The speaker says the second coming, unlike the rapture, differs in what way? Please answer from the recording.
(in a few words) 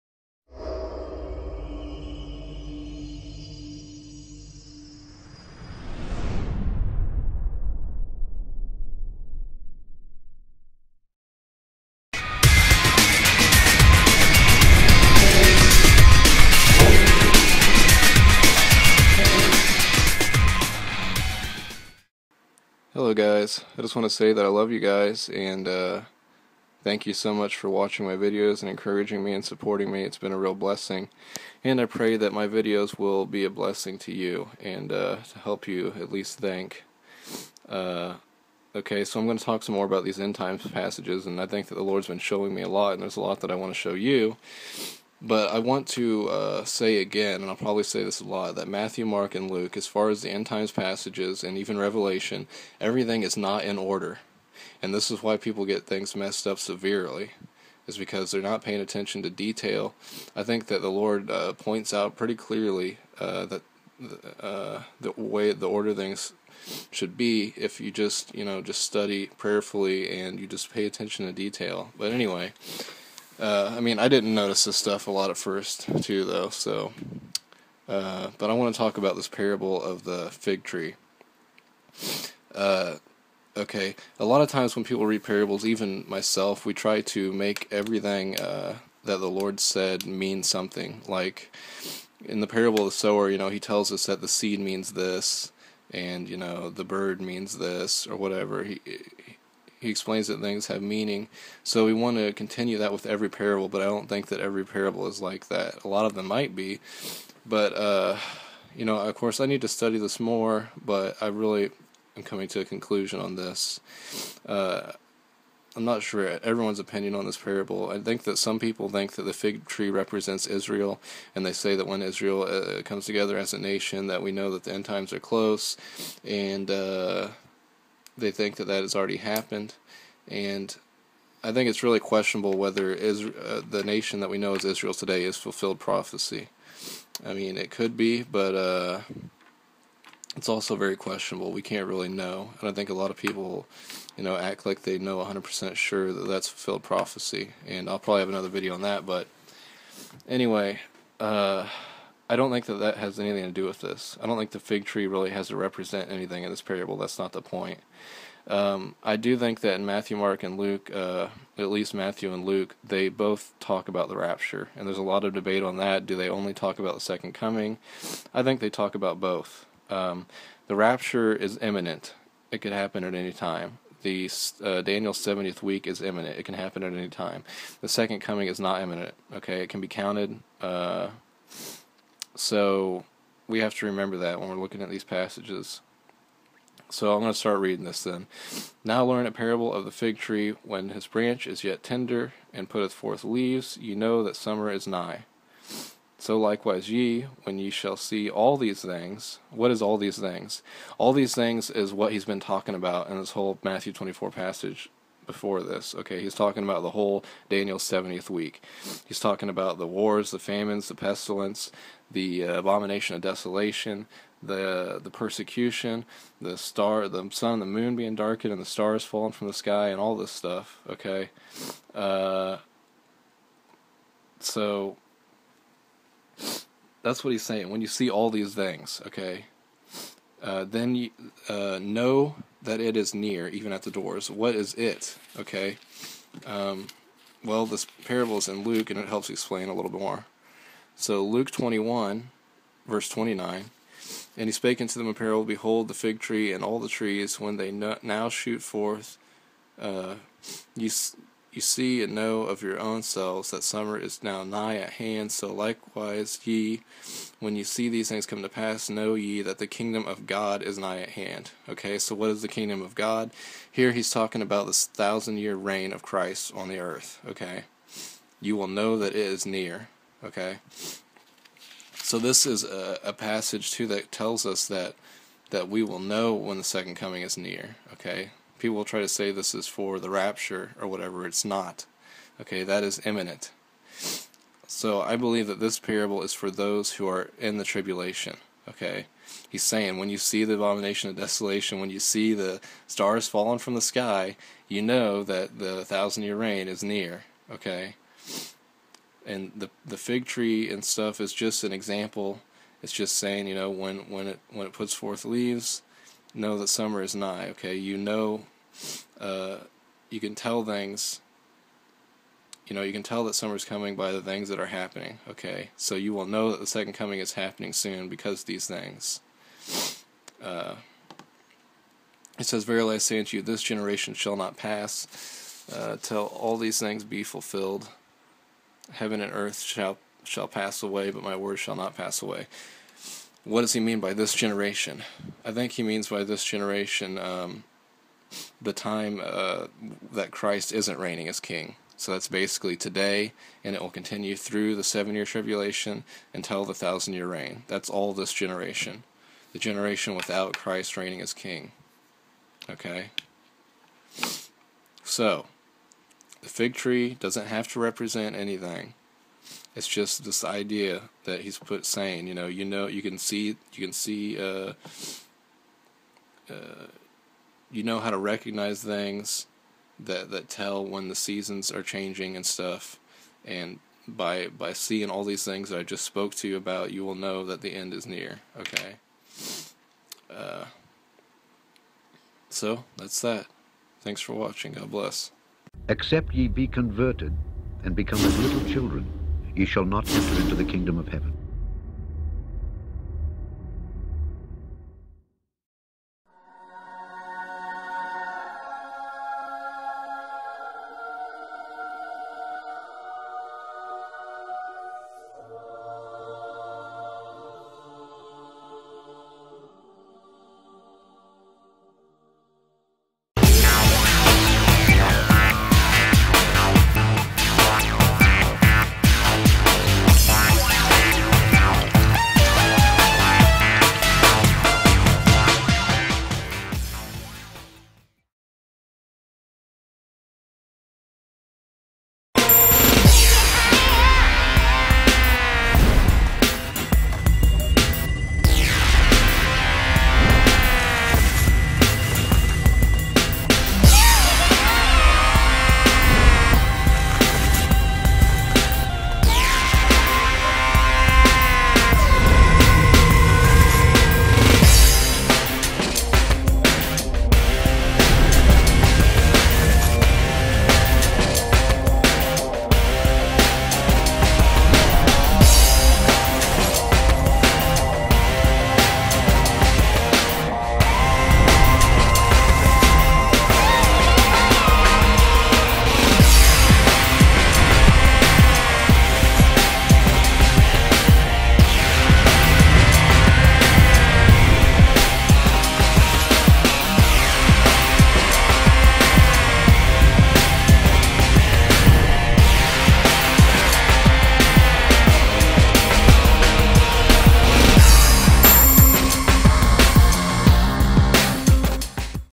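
it can be counted.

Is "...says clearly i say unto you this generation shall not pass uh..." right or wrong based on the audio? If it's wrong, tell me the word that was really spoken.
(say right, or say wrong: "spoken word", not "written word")
wrong: "verily", not "clearly".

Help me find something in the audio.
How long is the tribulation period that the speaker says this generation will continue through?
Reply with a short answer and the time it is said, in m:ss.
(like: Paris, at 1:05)
7 years, at 5:44.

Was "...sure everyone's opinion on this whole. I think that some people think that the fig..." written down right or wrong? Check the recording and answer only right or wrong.
wrong.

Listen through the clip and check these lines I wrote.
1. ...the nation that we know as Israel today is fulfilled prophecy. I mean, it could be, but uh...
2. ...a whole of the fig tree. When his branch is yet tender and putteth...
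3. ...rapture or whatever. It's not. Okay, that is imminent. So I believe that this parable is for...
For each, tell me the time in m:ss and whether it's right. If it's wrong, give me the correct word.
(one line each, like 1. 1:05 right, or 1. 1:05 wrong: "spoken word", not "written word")
1. 2:13 right
2. 3:09 wrong: "parable", not "whole"
3. 4:40 right.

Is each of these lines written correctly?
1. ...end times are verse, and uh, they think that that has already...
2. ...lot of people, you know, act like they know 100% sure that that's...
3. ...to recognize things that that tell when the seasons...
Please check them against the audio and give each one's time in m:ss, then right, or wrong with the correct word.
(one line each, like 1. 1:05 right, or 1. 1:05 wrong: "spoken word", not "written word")
1. 2:04 wrong: "close", not "verse"
2. 2:22 right
3. 6:08 right.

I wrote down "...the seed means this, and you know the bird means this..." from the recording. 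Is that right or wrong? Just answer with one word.
right.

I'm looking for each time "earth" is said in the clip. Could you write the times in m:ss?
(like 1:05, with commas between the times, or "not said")
4:26, 5:29.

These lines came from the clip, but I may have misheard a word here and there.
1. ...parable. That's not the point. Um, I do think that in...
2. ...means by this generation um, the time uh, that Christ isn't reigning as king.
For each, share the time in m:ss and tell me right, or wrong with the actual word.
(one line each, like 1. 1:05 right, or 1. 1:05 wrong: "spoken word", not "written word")
1. 2:36 right
2. 5:35 right.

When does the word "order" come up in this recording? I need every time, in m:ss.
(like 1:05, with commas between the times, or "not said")
0:53, 1:05.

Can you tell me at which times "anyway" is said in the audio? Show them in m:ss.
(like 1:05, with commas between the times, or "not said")
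1:12, 2:30.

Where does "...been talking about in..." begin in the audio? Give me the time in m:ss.
3:22.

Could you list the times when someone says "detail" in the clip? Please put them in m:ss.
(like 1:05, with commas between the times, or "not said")
0:59, 1:11.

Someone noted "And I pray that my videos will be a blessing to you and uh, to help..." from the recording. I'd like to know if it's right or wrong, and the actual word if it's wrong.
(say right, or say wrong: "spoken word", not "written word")
right.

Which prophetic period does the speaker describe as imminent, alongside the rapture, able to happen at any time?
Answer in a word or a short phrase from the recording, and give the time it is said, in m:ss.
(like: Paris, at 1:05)
Daniel's seventieth week, at 2:54.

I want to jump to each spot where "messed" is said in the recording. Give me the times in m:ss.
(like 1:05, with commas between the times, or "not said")
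0:56.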